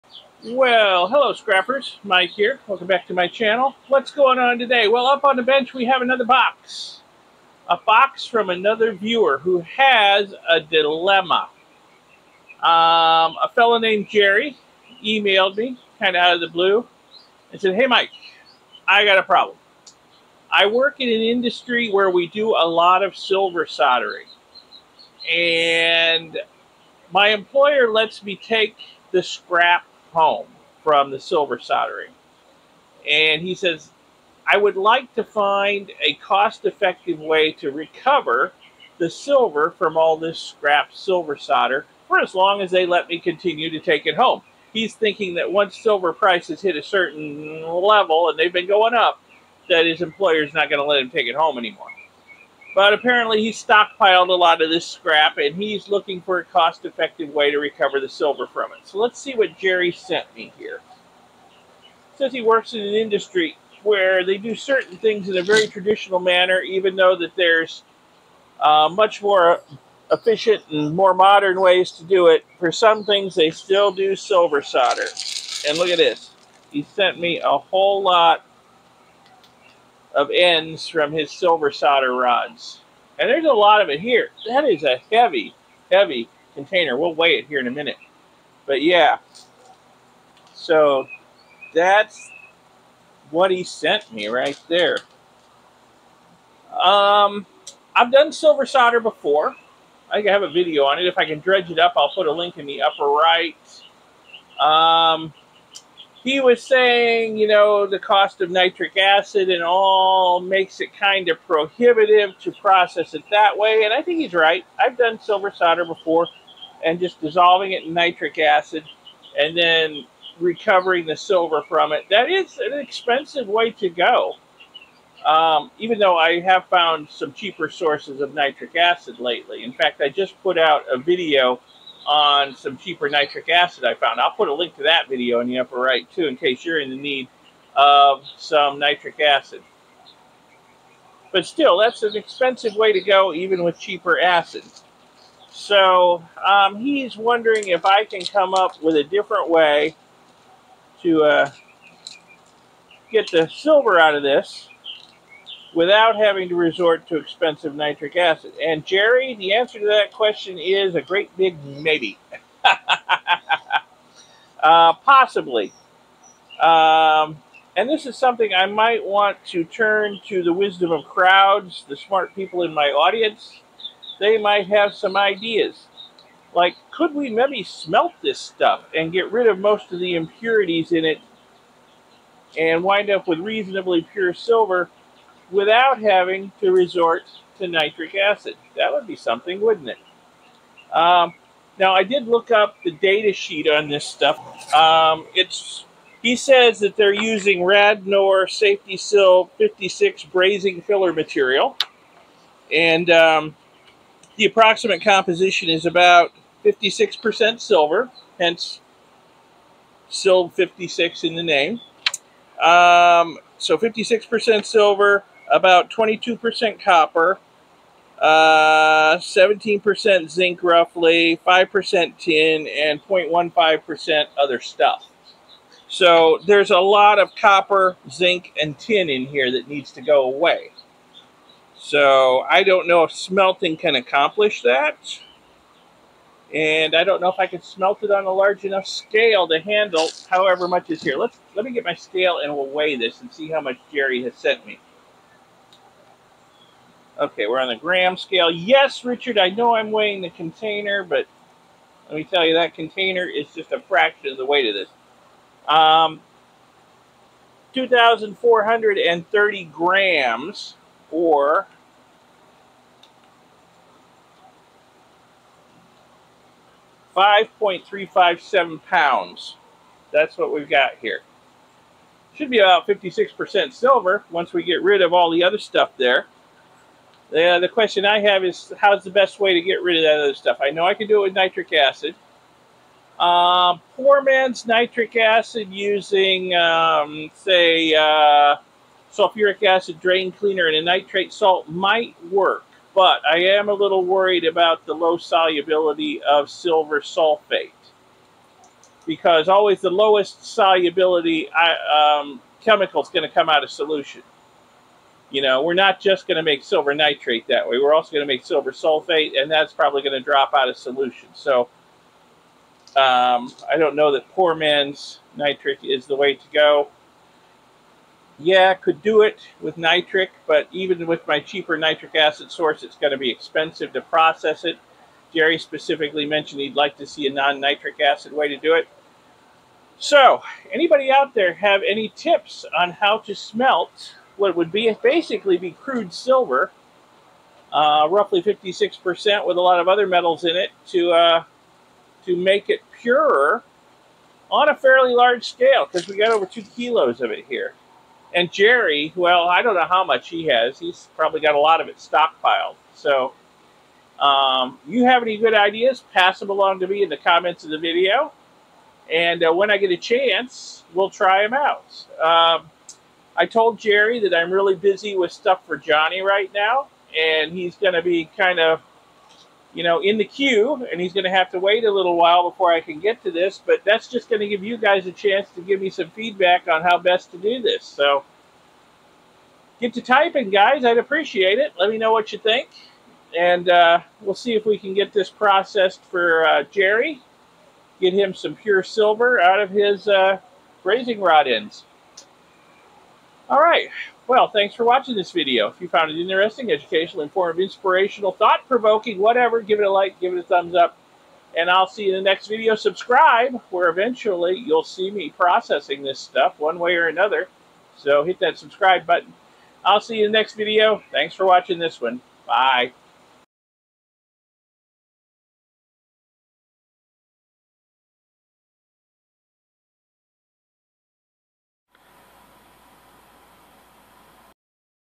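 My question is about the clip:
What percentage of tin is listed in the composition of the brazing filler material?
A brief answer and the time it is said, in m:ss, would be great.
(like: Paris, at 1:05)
5%, at 3:41.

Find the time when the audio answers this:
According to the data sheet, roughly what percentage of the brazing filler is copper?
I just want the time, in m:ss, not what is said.
3:35.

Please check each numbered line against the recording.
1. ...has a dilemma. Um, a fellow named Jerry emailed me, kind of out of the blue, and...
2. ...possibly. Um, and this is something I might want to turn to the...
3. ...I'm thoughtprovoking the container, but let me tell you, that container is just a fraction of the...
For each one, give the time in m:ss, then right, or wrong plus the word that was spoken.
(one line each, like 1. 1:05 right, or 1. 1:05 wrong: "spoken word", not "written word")
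1. 0:09 right
2. 2:44 right
3. 4:09 wrong: "weighing", not "thoughtprovoking".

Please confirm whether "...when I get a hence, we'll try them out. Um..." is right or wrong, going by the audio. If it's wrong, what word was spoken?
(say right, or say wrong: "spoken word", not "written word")
wrong: "chance", not "hence".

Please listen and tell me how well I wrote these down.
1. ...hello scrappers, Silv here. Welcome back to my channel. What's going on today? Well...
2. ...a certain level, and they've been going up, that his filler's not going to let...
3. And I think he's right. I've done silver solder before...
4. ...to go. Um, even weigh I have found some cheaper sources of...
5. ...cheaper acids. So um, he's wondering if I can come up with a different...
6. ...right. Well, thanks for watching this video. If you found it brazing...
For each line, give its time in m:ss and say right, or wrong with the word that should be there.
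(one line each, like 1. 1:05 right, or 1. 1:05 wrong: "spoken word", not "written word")
1. 0:01 wrong: "Mike", not "Silv"
2. 0:46 wrong: "employer", not "filler"
3. 1:53 right
4. 2:03 wrong: "though", not "weigh"
5. 2:23 right
6. 6:33 wrong: "interesting", not "brazing".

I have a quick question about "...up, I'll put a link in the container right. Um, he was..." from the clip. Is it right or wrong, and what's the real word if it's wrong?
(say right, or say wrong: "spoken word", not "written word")
wrong: "upper", not "container".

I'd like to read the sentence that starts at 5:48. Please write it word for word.
And Jerry, well, I don't know how much he has.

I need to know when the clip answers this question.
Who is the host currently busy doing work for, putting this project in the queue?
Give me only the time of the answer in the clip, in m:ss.
6:05.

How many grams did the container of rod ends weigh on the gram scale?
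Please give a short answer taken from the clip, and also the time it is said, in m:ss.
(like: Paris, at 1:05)
2,430 grams, at 4:17.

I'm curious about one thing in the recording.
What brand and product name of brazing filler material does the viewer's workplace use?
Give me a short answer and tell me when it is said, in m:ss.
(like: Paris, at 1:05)
Radnor Safety-Silv 56, at 3:17.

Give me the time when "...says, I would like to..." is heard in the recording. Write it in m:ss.
0:33.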